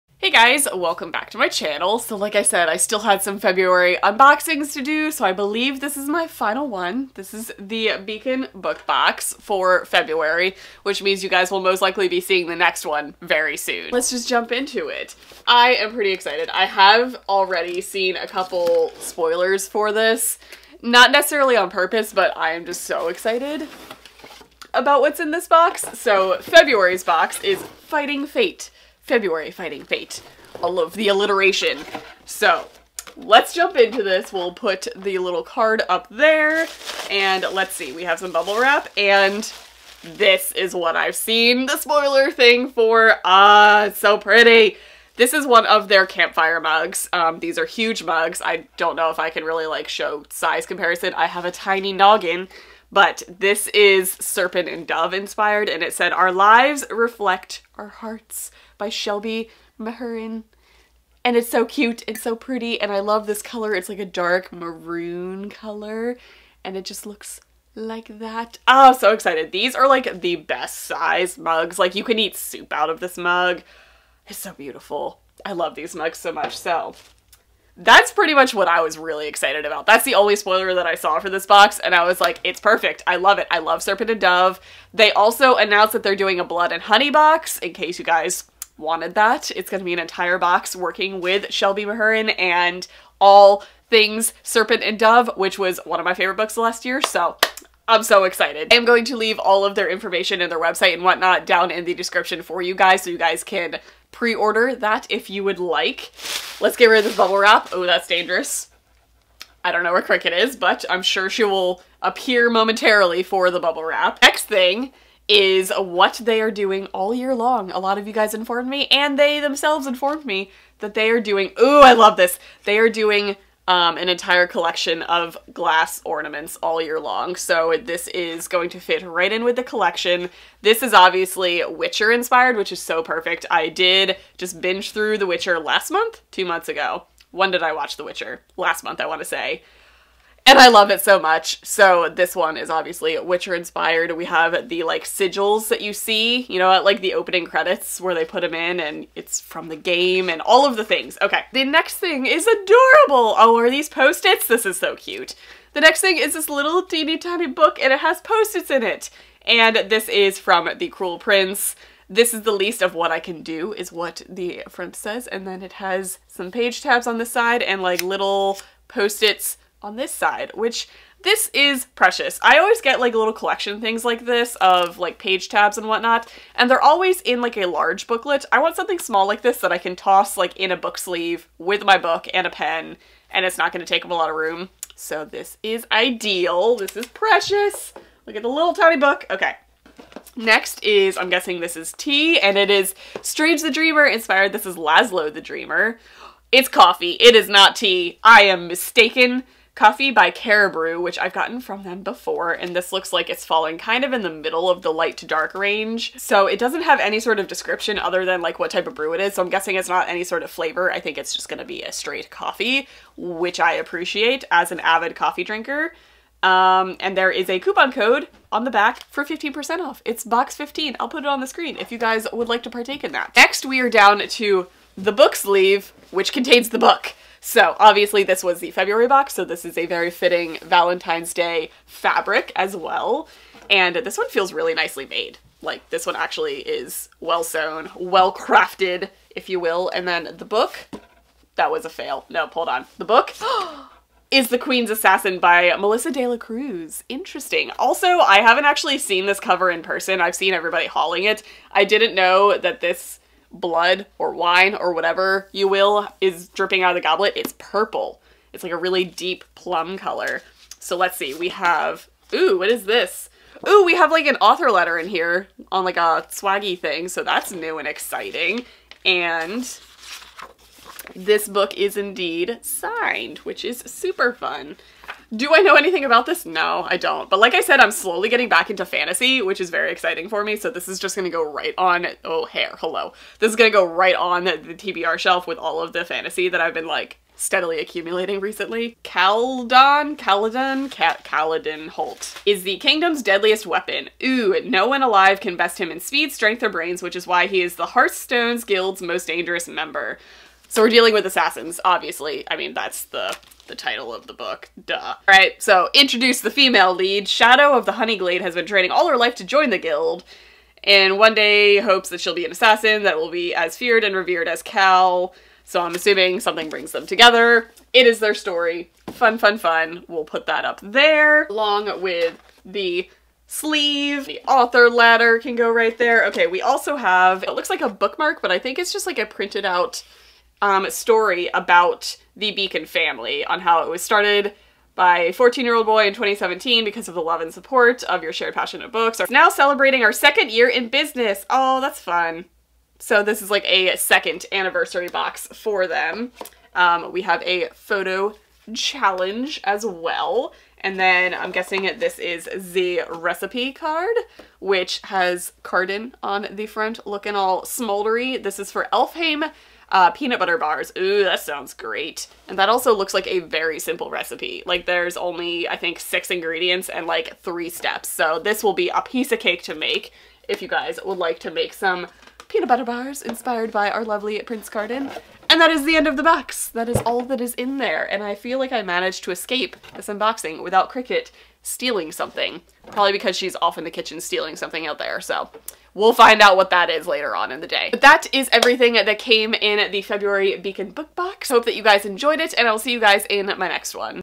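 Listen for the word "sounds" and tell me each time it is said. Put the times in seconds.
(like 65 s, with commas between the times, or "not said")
361 s.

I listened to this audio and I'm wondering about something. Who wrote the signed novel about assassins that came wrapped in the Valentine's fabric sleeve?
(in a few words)
Melissa De La Cruz.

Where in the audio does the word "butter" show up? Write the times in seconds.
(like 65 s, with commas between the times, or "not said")
360 s, 372 s.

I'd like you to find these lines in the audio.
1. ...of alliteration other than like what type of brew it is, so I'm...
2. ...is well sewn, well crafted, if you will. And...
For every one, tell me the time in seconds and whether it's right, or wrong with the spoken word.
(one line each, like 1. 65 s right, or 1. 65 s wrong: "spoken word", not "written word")
1. 207 s wrong: "description", not "alliteration"
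2. 236 s right.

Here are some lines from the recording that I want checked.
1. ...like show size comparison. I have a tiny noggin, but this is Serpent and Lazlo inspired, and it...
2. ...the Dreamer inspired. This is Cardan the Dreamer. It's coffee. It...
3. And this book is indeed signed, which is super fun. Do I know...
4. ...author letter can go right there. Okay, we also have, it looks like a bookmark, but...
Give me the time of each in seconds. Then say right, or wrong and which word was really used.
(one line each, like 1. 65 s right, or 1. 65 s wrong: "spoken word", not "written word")
1. 49 s wrong: "Dove", not "Lazlo"
2. 193 s wrong: "Lazlo", not "Cardan"
3. 269 s right
4. 324 s right.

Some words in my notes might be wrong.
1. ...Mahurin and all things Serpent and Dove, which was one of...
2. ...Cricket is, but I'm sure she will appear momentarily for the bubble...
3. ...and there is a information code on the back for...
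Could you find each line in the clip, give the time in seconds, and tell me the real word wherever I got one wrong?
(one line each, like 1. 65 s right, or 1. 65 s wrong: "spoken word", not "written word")
1. 91 s right
2. 110 s right
3. 216 s wrong: "coupon", not "information".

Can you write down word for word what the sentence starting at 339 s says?
We're now celebrating our second year in business.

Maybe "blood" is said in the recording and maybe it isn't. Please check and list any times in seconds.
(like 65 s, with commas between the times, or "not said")
86 s, 253 s.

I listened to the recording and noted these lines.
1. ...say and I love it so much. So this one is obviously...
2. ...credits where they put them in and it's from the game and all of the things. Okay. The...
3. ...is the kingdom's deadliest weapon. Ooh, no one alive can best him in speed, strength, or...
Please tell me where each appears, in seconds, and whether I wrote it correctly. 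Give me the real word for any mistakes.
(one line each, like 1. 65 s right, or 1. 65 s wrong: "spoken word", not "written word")
1. 139 s right
2. 147 s right
3. 292 s right.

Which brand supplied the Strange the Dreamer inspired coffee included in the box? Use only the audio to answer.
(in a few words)
Caribou.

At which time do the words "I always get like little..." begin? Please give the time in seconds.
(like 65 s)
172 s.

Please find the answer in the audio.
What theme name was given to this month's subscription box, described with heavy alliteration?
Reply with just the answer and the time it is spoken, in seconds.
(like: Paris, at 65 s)
Fighting Fate February, at 27 s.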